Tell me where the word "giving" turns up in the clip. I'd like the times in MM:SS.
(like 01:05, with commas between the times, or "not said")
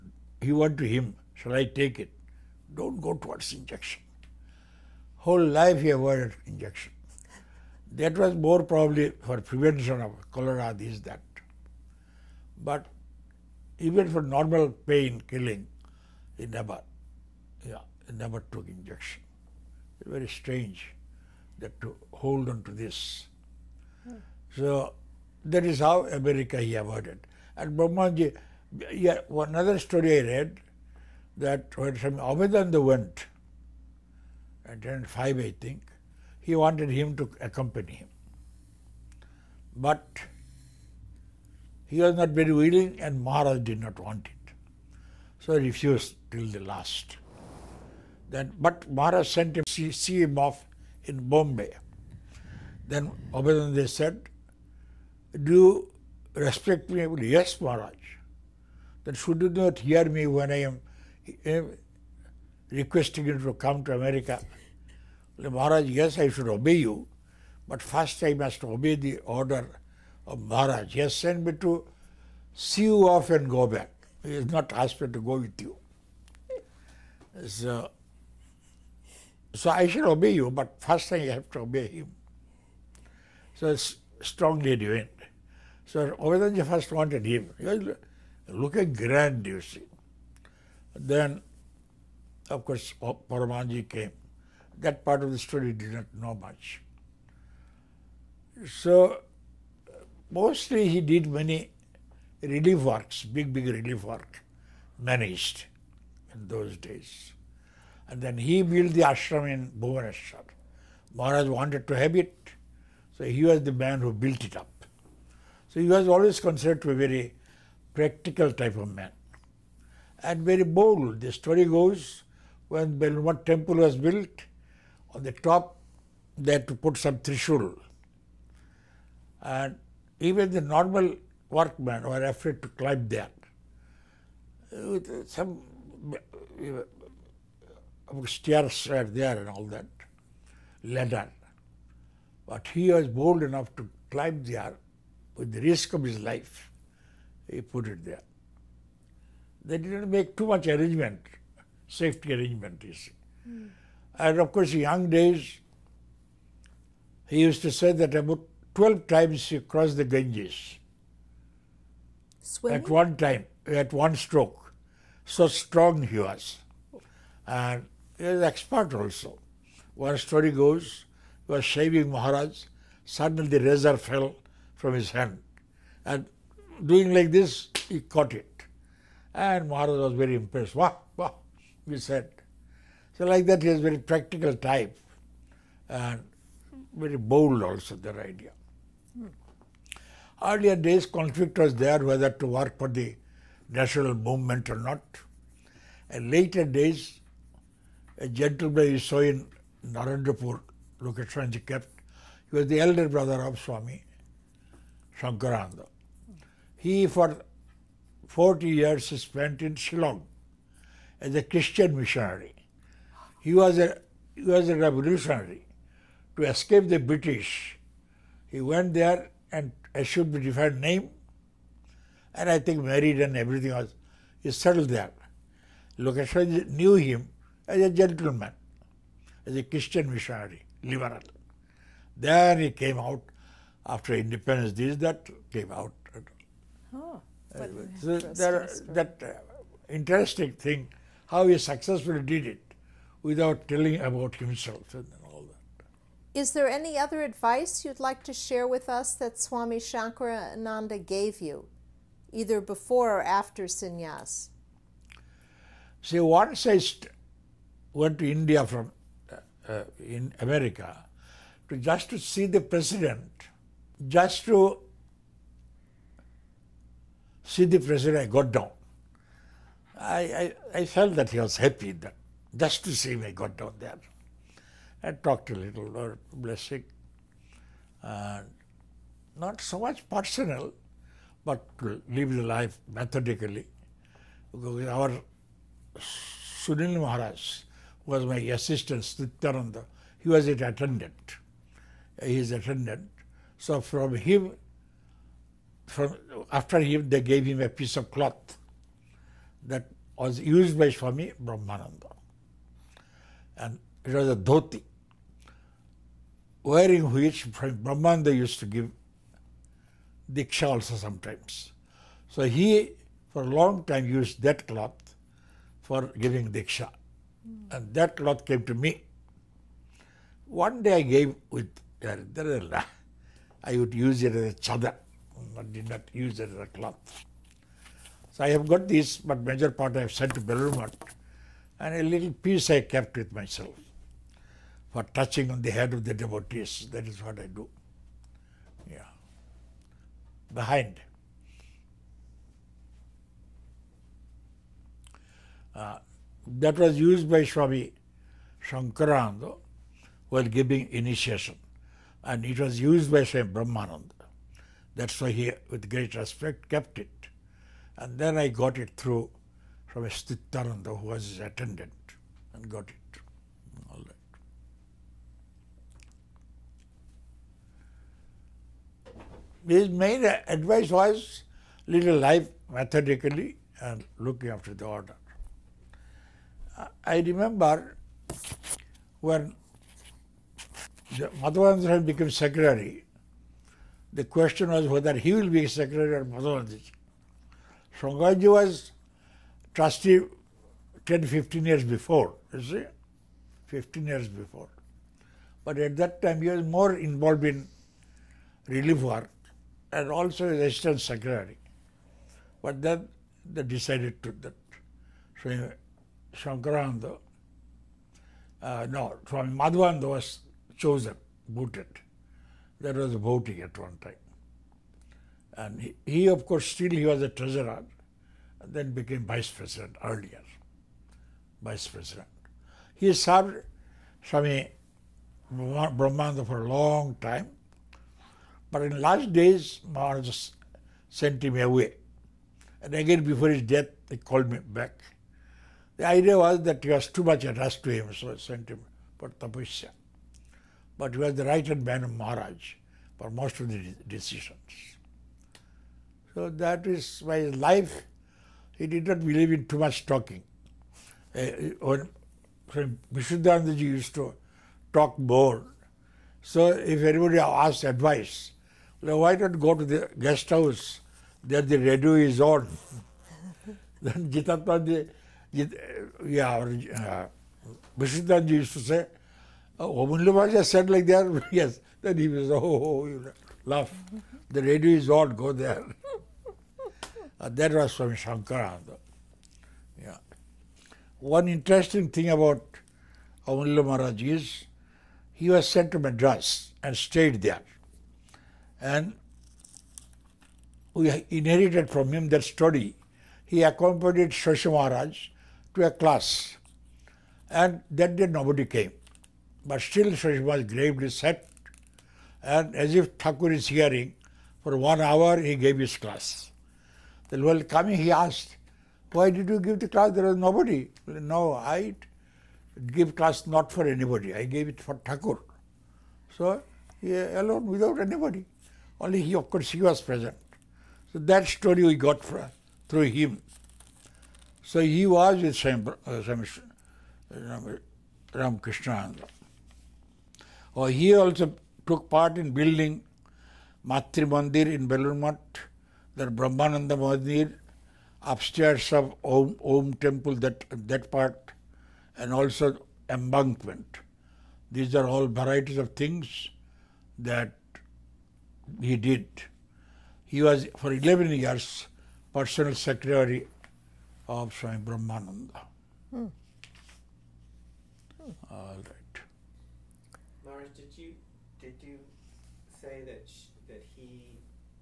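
05:16, 05:50.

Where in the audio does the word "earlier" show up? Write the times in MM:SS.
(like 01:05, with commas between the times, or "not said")
03:10, 07:00.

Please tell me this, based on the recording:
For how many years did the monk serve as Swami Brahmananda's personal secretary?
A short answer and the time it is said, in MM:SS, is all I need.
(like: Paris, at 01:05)
11, at 09:10.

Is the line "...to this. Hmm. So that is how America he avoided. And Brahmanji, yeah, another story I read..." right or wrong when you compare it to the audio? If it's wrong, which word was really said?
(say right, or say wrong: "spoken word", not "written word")
right.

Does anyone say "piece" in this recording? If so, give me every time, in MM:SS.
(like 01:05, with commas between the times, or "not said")
04:57, 05:32.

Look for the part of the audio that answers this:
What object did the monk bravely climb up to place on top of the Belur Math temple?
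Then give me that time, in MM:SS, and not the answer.
02:07.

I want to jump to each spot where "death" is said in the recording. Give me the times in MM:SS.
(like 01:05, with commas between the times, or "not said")
07:13.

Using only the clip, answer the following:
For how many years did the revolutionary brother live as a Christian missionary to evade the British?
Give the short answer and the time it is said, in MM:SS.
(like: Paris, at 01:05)
40, at 03:28.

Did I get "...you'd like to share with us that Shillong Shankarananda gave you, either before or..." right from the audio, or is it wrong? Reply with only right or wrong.
wrong.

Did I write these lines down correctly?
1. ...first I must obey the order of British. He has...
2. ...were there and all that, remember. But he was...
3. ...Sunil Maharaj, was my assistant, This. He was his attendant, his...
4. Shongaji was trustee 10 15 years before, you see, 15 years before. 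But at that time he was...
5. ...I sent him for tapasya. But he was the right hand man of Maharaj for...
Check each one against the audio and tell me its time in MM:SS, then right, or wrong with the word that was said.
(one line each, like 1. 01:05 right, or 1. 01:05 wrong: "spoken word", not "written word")
1. 01:07 wrong: "Maharaj", not "British"
2. 02:18 wrong: "ladder", not "remember"
3. 04:45 wrong: "Srityananda", not "This"
4. 06:28 right
5. 07:18 right.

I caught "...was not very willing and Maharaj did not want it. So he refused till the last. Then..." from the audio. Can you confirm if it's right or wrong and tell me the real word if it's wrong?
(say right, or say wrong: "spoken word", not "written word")
right.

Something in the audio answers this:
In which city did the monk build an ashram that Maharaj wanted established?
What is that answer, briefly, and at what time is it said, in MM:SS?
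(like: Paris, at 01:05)
Bhuvaneshwar, at 01:49.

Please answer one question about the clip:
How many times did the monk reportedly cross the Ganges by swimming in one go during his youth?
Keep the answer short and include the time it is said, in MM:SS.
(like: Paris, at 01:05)
12, at 02:38.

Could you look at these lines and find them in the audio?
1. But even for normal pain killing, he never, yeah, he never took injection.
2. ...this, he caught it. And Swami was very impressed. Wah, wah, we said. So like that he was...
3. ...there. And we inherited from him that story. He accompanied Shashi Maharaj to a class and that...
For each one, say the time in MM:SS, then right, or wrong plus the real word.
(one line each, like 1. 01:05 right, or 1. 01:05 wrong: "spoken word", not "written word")
1. 00:12 right
2. 02:57 wrong: "Maharaj", not "Swami"
3. 08:07 right.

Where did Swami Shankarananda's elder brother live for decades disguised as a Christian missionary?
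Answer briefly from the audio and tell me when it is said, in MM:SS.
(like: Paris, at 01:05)
Shillong, at 03:29.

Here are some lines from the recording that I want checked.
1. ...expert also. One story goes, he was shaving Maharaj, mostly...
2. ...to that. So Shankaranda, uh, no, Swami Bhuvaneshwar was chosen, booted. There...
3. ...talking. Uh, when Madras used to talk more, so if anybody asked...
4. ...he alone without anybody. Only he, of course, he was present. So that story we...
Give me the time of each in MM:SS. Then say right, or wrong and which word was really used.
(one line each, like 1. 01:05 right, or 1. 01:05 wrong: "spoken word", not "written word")
1. 02:48 wrong: "suddenly", not "mostly"
2. 06:44 wrong: "Madhvananda", not "Bhuvaneshwar"
3. 07:30 wrong: "Vishuddhanandaji", not "Madras"
4. 08:37 right.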